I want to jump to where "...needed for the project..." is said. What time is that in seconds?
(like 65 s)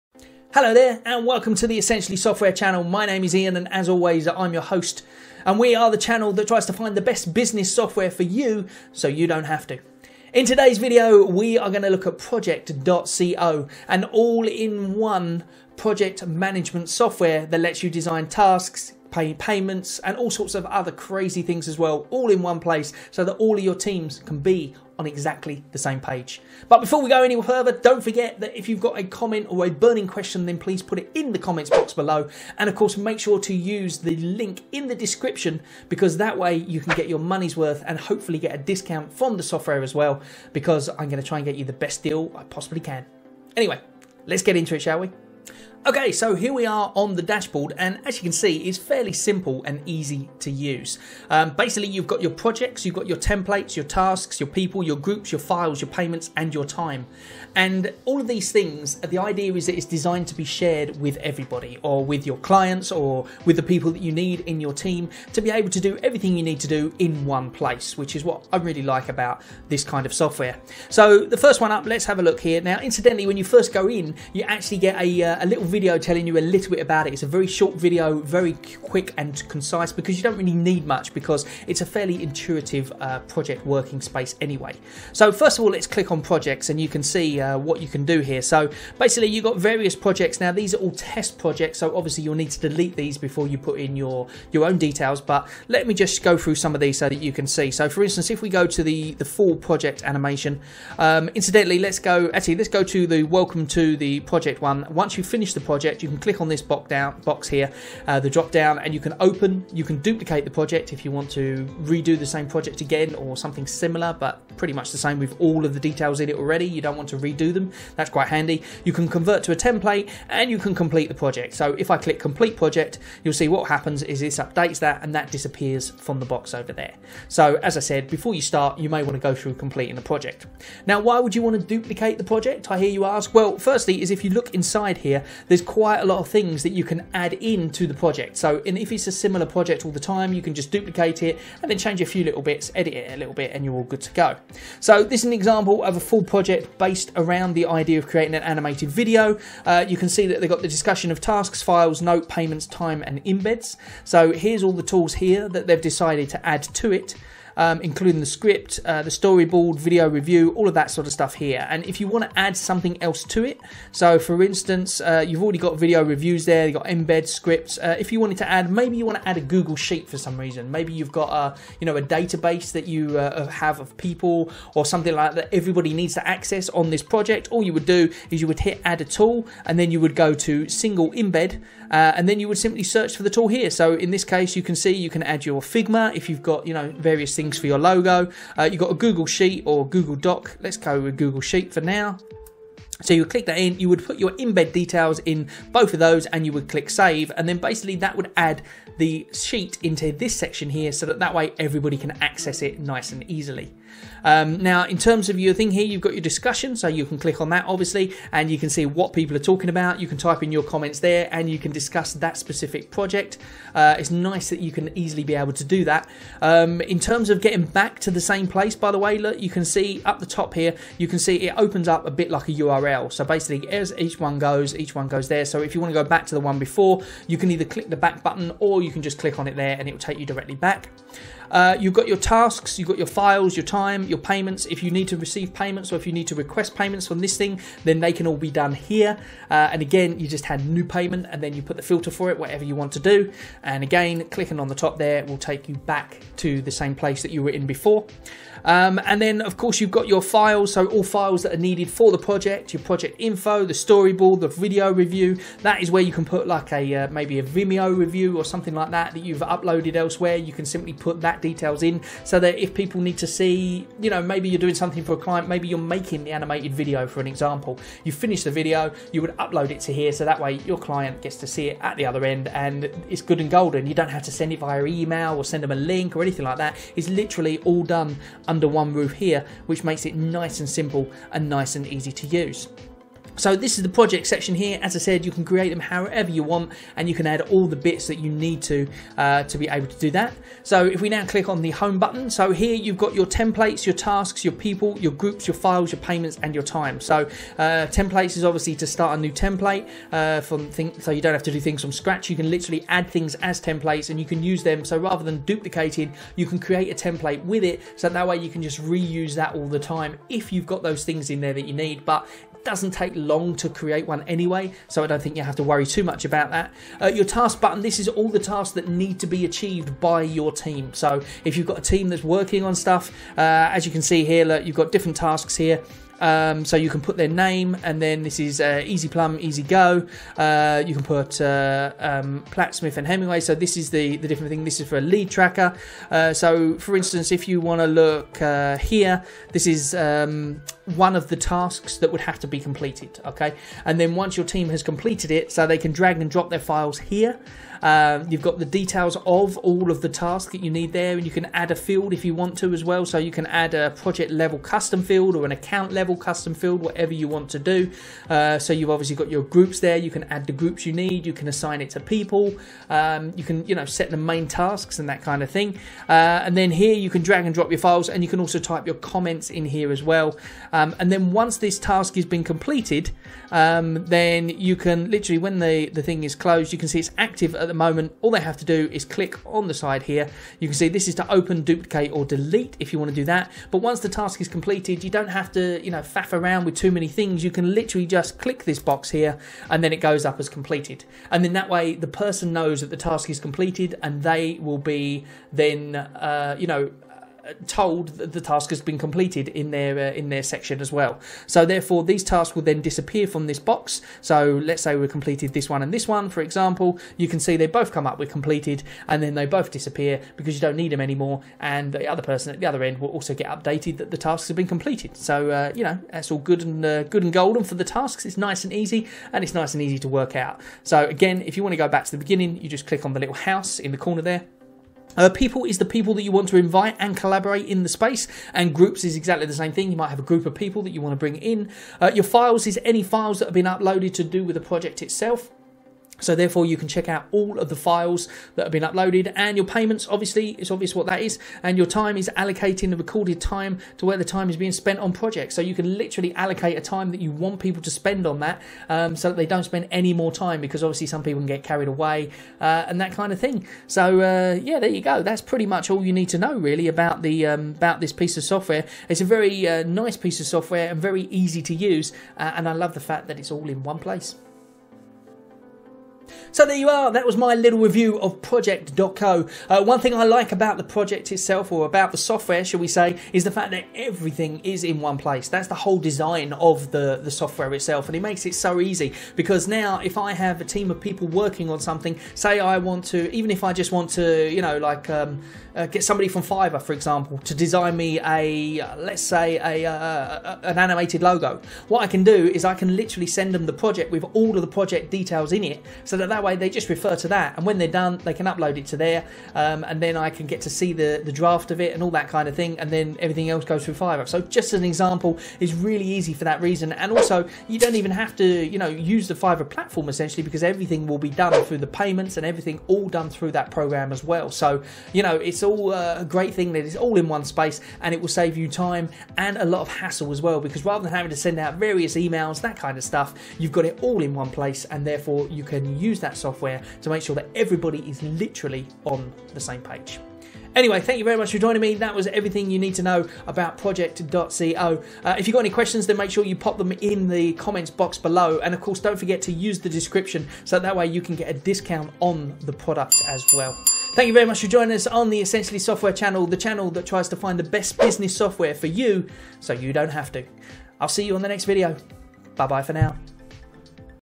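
251 s.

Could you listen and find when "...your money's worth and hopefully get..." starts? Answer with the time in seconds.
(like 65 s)
37 s.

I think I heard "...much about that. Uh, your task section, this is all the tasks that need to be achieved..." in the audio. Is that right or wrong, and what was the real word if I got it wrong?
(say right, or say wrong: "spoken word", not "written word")
wrong: "button", not "section".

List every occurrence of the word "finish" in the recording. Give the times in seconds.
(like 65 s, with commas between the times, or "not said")
105 s, 268 s.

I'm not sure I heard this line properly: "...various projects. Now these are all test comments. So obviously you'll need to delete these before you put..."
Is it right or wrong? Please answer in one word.
wrong.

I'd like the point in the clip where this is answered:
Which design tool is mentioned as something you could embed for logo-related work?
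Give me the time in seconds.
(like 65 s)
185 s.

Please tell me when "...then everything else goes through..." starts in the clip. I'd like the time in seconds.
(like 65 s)
502 s.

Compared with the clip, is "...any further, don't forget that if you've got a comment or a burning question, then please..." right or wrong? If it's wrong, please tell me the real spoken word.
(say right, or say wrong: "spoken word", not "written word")
right.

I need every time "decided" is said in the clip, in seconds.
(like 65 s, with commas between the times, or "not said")
155 s.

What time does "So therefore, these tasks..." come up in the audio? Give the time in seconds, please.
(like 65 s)
401 s.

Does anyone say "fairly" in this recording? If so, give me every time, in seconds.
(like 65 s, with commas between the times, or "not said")
48 s, 81 s.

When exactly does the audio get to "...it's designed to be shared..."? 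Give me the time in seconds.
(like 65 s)
59 s.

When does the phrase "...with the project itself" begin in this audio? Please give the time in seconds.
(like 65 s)
434 s.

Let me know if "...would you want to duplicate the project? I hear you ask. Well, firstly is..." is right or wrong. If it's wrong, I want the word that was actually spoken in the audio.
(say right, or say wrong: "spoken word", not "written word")
right.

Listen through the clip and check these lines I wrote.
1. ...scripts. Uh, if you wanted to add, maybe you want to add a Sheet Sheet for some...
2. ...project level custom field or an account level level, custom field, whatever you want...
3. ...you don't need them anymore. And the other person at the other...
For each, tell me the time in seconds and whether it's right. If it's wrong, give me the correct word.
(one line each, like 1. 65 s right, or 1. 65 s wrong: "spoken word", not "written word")
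1. 167 s wrong: "Google", not "Sheet"
2. 353 s right
3. 410 s right.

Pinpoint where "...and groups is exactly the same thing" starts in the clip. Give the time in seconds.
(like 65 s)
428 s.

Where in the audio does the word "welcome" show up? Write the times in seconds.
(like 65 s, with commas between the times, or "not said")
1 s, 103 s.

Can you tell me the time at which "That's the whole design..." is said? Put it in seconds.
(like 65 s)
475 s.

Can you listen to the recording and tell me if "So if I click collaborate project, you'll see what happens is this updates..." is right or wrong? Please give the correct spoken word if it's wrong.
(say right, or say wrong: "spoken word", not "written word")
wrong: "complete", not "collaborate".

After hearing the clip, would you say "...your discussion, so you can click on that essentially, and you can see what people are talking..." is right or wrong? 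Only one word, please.
wrong.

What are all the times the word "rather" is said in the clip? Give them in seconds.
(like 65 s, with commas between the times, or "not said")
304 s, 520 s.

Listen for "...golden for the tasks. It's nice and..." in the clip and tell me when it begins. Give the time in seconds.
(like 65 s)
417 s.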